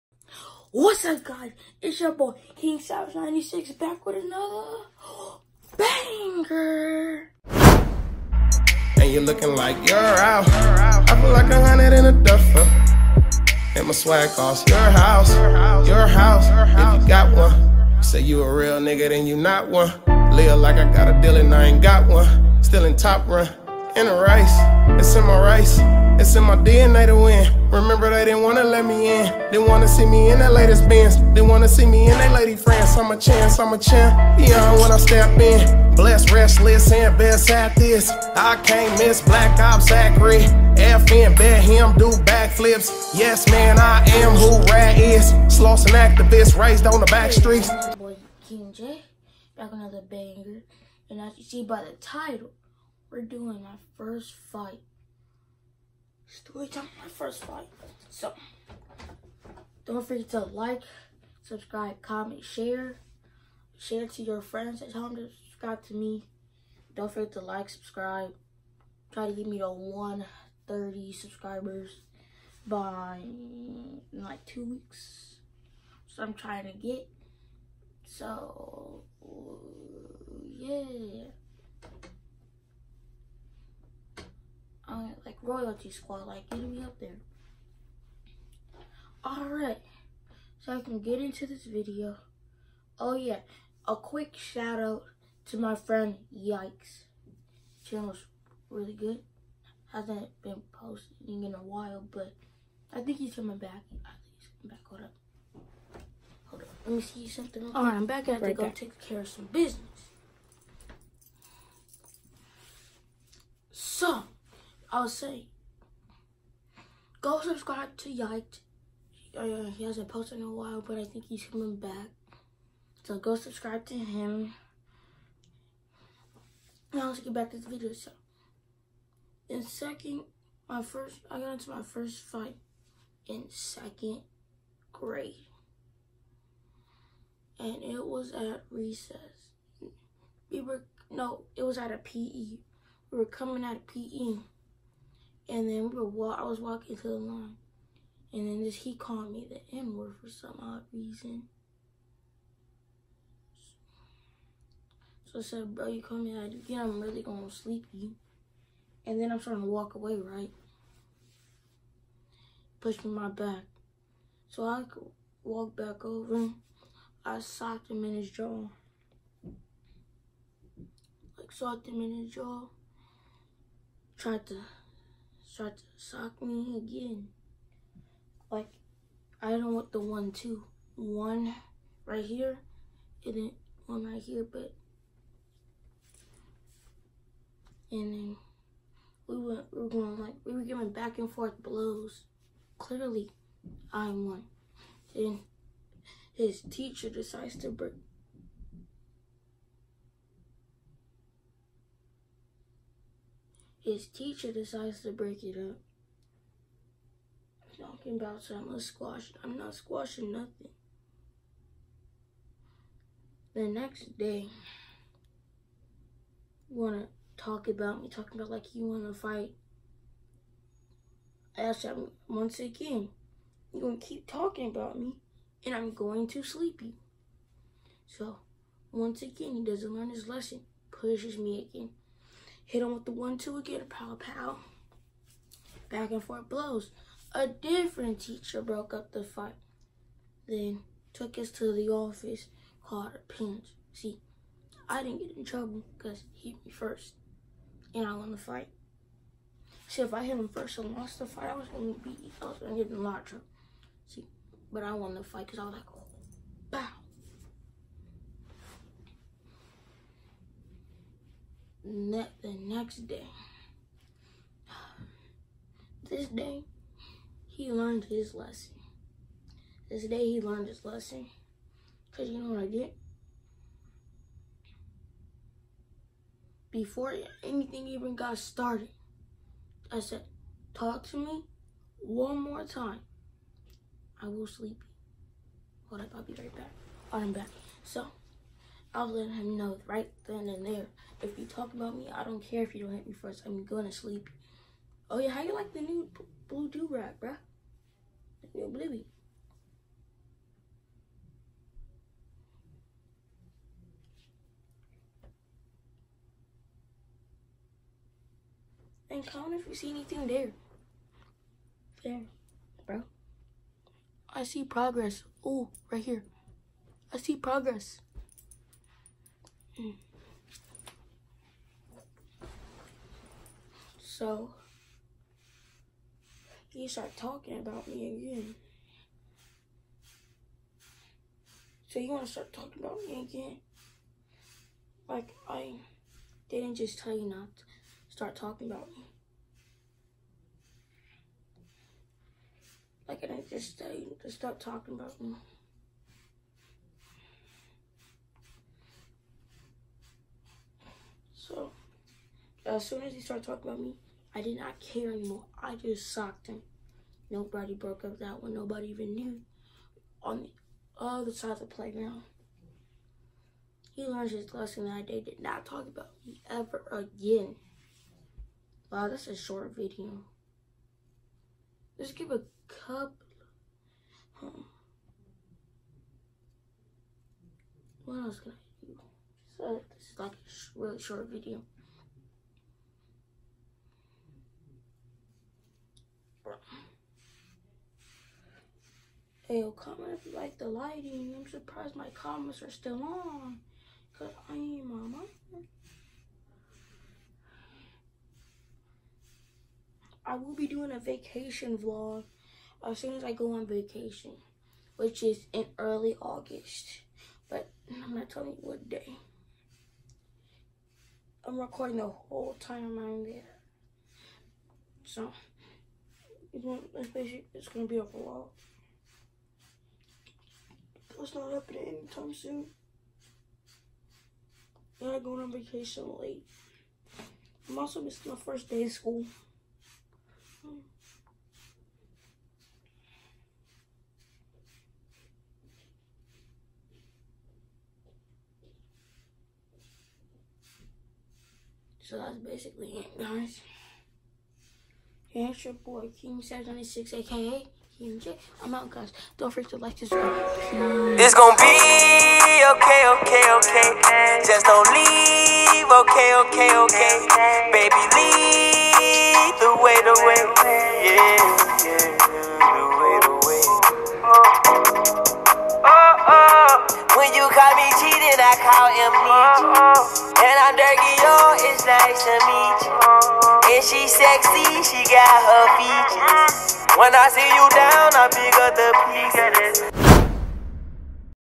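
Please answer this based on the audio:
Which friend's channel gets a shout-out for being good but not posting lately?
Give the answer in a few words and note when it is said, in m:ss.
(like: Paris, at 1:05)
Yikes, at 1:36.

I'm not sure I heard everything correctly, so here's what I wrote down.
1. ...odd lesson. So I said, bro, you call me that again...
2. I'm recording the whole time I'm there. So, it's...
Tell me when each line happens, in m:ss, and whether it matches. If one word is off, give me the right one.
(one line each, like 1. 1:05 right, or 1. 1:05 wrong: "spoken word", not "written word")
1. 2:30 wrong: "reason", not "lesson"
2. 6:51 right.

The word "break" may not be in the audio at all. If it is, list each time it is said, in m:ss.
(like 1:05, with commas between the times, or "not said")
3:17, 3:25.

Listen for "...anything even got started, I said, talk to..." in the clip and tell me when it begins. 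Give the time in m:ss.
4:37.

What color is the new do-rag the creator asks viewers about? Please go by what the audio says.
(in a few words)
Blue.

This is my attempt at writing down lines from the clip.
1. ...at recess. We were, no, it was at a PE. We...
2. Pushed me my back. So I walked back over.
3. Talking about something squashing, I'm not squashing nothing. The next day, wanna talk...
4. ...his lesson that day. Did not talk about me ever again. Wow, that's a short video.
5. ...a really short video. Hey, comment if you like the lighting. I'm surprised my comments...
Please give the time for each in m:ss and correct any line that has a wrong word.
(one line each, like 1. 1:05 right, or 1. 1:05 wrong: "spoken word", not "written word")
1. 2:18 right
2. 2:42 right
3. 3:27 right
4. 6:04 right
5. 6:20 right.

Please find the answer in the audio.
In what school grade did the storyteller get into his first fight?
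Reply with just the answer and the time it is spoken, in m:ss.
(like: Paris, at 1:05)
Second grade, at 2:13.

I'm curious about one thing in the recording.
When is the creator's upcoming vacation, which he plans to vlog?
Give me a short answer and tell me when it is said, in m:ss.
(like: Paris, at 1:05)
Early August, at 6:45.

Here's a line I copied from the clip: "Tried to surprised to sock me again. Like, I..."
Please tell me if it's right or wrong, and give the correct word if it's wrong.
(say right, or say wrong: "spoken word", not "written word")
wrong: "tried", not "surprised".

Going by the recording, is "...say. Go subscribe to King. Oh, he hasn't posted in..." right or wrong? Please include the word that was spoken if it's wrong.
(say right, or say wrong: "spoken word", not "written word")
wrong: "Yiked", not "King".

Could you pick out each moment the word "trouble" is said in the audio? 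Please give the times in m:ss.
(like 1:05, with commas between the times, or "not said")
4:05, 4:13.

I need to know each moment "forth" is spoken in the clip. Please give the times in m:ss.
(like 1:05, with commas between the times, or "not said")
3:11, 3:56.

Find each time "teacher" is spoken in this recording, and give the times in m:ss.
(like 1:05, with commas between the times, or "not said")
3:16, 3:24, 3:58.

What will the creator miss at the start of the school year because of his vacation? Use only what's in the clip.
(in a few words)
First day of school.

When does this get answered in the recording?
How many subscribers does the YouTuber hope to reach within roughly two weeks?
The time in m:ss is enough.
1:09.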